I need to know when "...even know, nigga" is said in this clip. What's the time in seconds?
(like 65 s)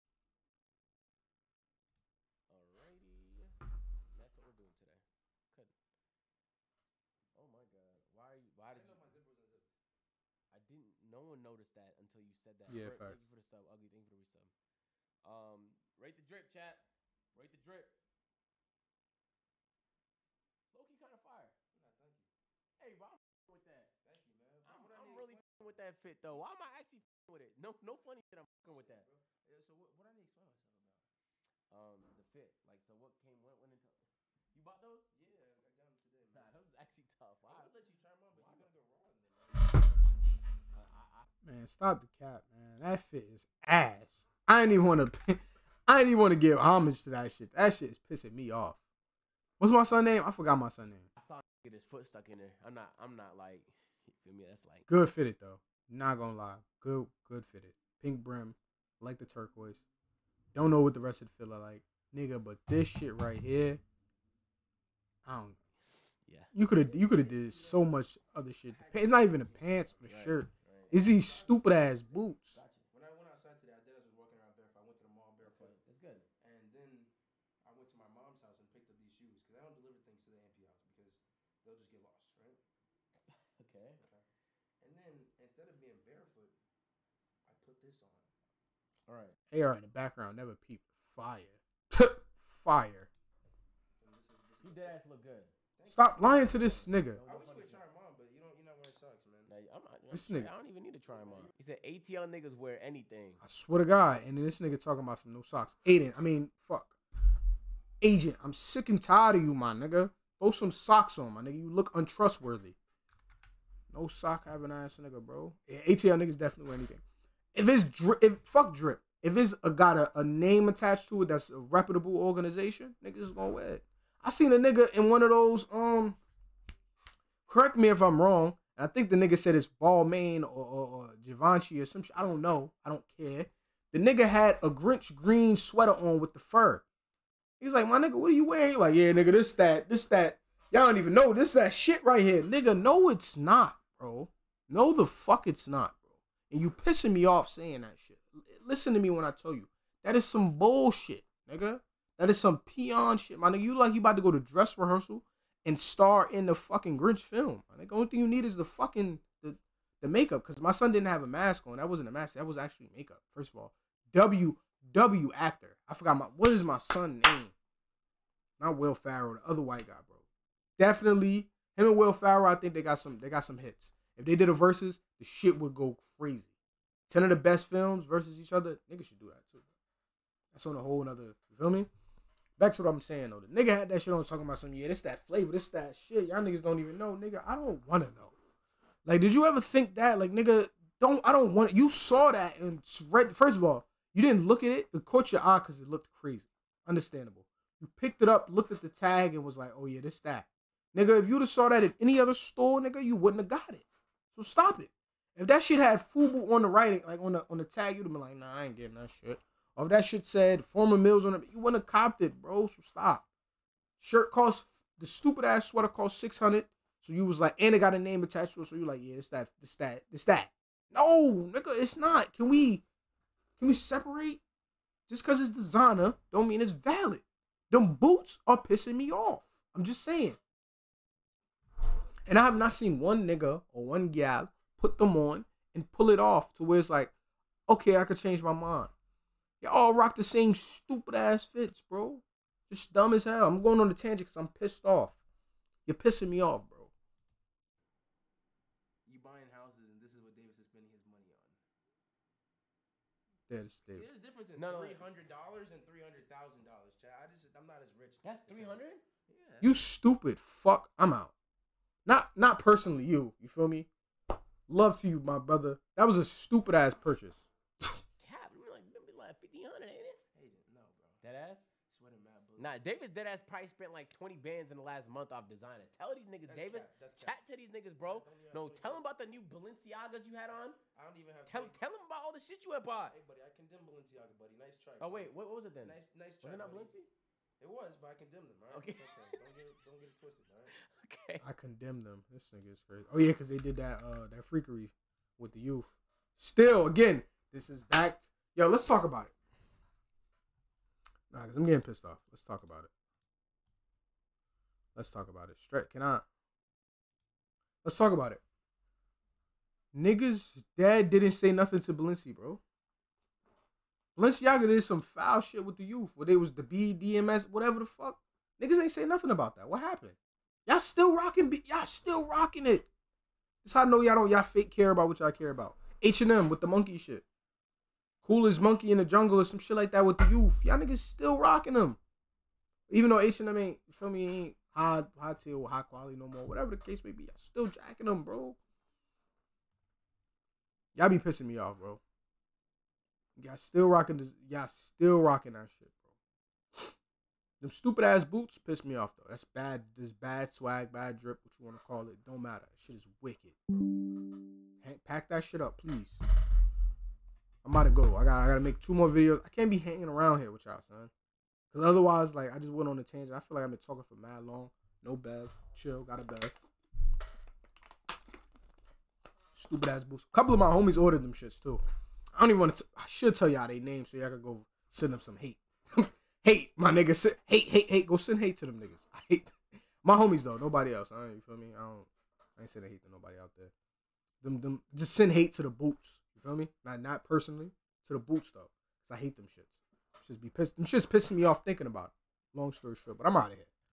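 186 s.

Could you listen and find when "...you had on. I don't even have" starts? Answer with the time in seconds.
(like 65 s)
280 s.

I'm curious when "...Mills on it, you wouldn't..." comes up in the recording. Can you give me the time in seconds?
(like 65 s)
210 s.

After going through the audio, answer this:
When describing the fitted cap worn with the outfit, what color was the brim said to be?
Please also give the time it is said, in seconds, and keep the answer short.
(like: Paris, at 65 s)
Pink, at 58 s.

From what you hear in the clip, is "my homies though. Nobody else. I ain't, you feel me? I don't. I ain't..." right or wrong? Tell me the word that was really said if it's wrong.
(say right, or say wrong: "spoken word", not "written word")
right.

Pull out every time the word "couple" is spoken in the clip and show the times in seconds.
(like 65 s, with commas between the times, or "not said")
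370 s.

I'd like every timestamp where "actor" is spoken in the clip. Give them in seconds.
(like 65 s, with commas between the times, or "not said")
165 s.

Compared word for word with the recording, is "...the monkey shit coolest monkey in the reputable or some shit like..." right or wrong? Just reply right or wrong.
wrong.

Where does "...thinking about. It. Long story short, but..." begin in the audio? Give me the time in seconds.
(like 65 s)
391 s.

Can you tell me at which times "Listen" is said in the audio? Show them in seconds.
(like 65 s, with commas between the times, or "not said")
148 s.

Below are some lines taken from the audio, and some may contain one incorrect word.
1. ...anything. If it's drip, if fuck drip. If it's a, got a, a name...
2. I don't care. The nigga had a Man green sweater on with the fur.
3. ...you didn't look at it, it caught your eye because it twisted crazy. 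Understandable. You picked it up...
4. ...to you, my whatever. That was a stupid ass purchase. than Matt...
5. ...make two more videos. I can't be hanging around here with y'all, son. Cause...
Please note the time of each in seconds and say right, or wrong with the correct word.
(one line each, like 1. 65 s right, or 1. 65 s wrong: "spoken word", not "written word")
1. 116 s right
2. 132 s wrong: "Grinch", not "Man"
3. 194 s wrong: "looked", not "twisted"
4. 265 s wrong: "brother", not "whatever"
5. 358 s right.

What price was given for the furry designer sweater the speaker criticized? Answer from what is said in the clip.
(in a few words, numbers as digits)
600.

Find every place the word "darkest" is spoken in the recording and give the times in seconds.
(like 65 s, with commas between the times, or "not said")
not said.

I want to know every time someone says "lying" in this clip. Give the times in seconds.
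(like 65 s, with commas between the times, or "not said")
96 s.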